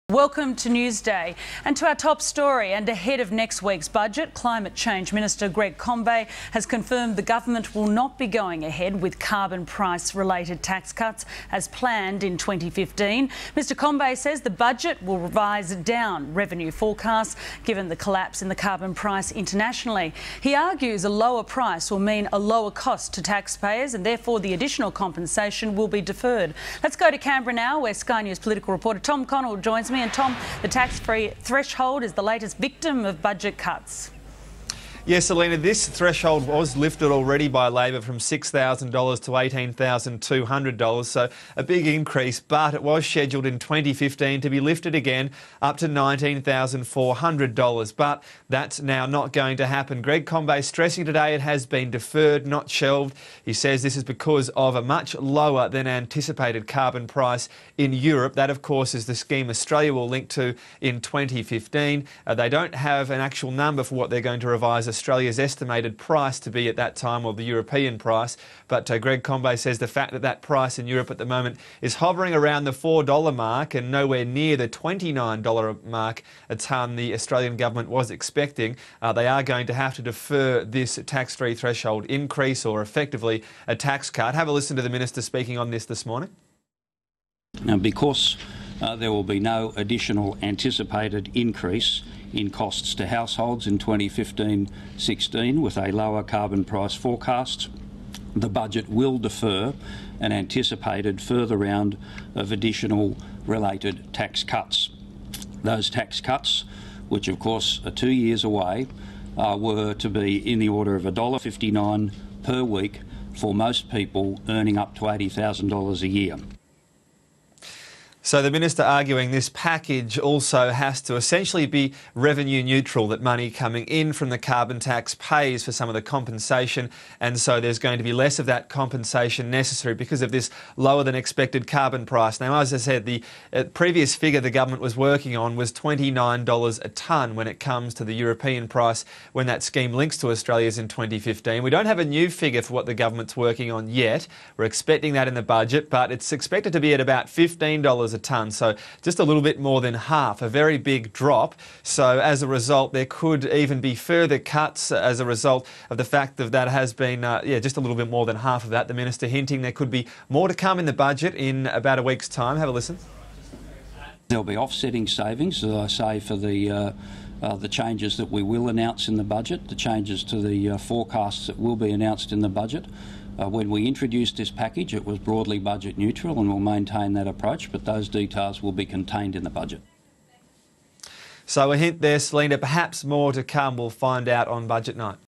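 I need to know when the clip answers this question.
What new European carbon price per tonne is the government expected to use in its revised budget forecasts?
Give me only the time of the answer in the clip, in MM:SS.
02:27.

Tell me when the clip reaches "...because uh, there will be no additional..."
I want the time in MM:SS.
01:27.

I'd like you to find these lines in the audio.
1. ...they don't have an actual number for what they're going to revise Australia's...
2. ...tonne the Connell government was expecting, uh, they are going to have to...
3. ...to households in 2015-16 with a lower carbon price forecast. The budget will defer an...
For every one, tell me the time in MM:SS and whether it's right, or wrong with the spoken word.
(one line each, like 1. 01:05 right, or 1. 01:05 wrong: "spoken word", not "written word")
1. 01:02 right
2. 01:16 wrong: "Australian", not "Connell"
3. 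01:32 right.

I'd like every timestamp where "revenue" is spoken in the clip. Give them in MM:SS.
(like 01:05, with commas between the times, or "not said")
00:16, 02:02.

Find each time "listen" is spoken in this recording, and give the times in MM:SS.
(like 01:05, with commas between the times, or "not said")
01:24, 02:42.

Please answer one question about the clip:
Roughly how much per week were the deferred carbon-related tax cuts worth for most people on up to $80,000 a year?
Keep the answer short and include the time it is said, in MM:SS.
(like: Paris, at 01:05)
$1.59, at 01:51.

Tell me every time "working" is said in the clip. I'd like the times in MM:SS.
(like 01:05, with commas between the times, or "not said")
02:14, 02:23.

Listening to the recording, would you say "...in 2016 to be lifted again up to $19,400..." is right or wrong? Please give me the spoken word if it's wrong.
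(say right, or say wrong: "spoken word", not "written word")
wrong: "2015", not "2016".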